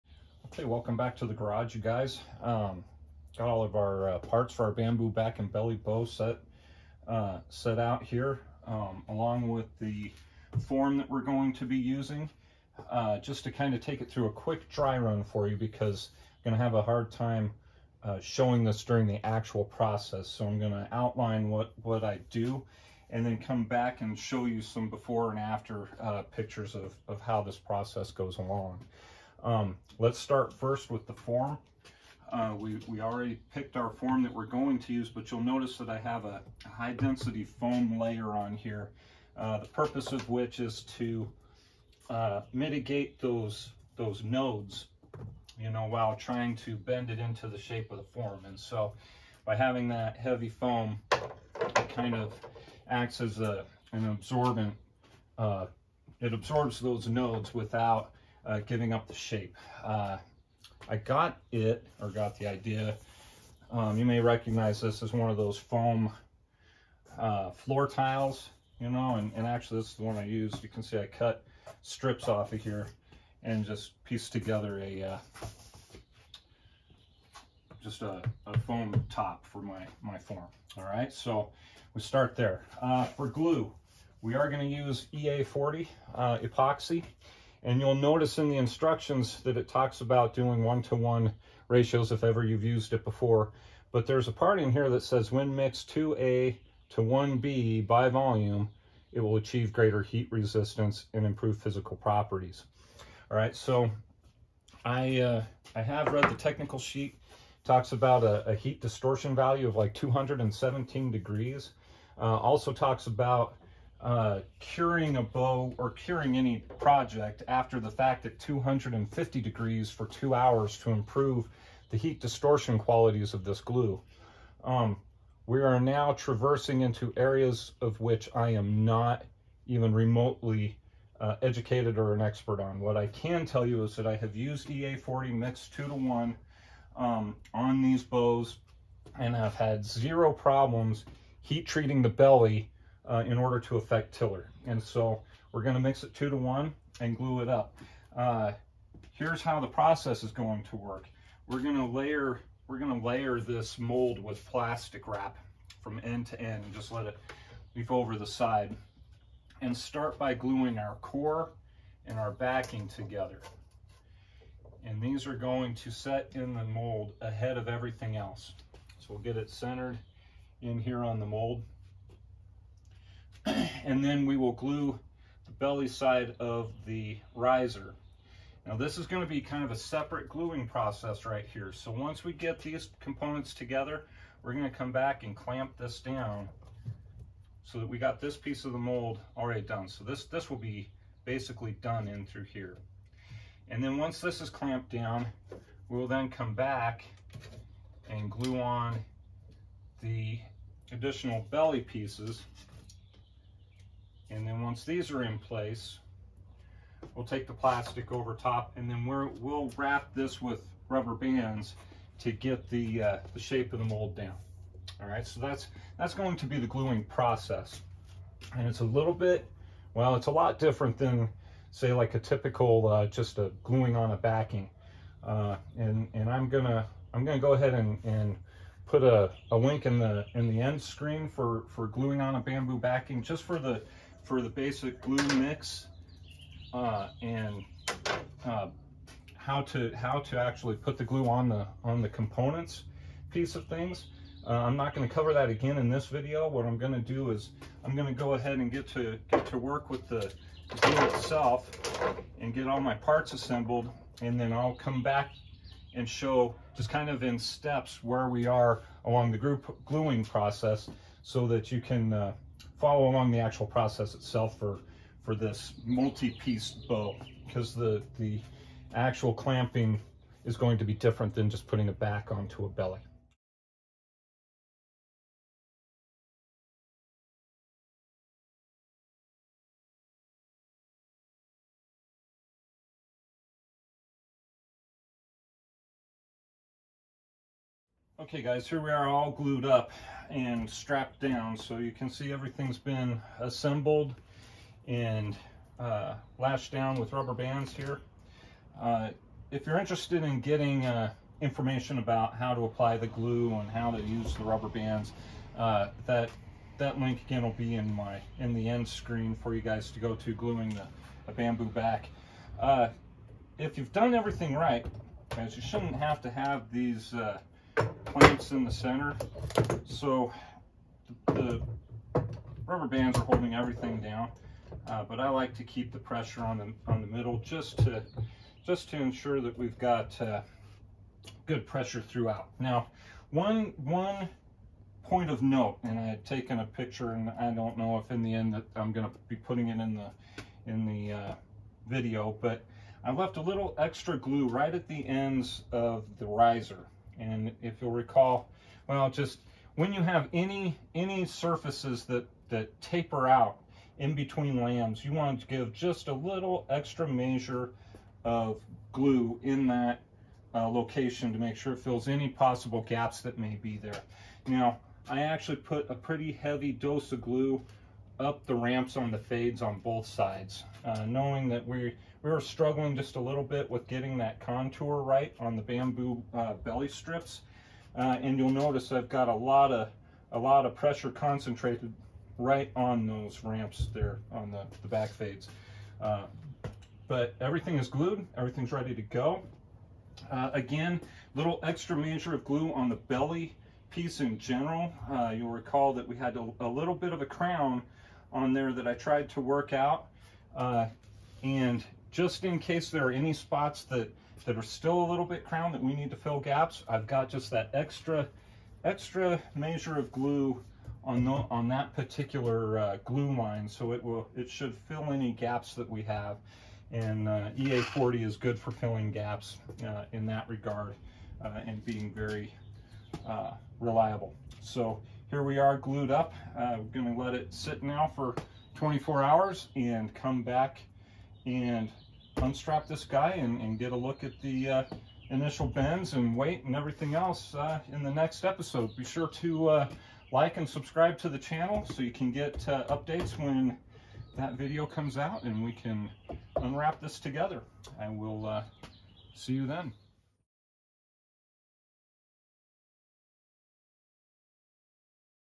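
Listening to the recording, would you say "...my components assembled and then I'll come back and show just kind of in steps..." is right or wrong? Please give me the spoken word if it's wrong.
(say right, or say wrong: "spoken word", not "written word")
wrong: "parts", not "components".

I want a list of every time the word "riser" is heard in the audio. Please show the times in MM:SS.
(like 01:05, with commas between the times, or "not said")
02:57, 05:46.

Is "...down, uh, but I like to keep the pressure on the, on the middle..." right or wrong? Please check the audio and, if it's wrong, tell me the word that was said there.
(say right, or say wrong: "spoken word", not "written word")
right.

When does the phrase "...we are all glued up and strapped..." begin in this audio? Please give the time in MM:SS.
04:48.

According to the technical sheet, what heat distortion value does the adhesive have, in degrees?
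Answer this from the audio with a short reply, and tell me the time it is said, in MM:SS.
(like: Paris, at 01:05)
217, at 01:49.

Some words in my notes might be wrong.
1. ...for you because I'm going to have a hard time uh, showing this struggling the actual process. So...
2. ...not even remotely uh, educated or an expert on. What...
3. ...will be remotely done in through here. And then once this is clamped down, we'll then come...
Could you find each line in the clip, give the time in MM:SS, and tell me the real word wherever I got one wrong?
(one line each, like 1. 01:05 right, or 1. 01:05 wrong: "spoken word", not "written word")
1. 00:15 wrong: "during", not "struggling"
2. 02:08 right
3. 03:10 wrong: "basically", not "remotely".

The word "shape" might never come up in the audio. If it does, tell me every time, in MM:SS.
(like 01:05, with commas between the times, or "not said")
00:47, 00:59, 03:33.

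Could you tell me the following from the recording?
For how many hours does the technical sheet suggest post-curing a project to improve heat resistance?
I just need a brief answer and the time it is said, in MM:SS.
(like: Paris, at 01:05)
2, at 02:00.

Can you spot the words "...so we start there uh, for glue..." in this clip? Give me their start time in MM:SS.
01:21.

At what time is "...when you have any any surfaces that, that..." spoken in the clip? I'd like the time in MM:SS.
05:49.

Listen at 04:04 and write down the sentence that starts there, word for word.
Uh, I'm not going to cover that again in this video.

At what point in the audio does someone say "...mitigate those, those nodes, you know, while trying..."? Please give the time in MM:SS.
00:42.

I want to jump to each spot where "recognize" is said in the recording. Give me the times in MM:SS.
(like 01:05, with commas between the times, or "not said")
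01:04.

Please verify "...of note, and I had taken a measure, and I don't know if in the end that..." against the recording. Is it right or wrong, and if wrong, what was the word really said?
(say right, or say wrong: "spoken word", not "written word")
wrong: "picture", not "measure".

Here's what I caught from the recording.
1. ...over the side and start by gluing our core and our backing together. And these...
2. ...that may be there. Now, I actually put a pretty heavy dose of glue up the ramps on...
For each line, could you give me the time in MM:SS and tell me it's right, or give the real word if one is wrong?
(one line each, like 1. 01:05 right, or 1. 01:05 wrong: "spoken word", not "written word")
1. 02:37 right
2. 06:03 right.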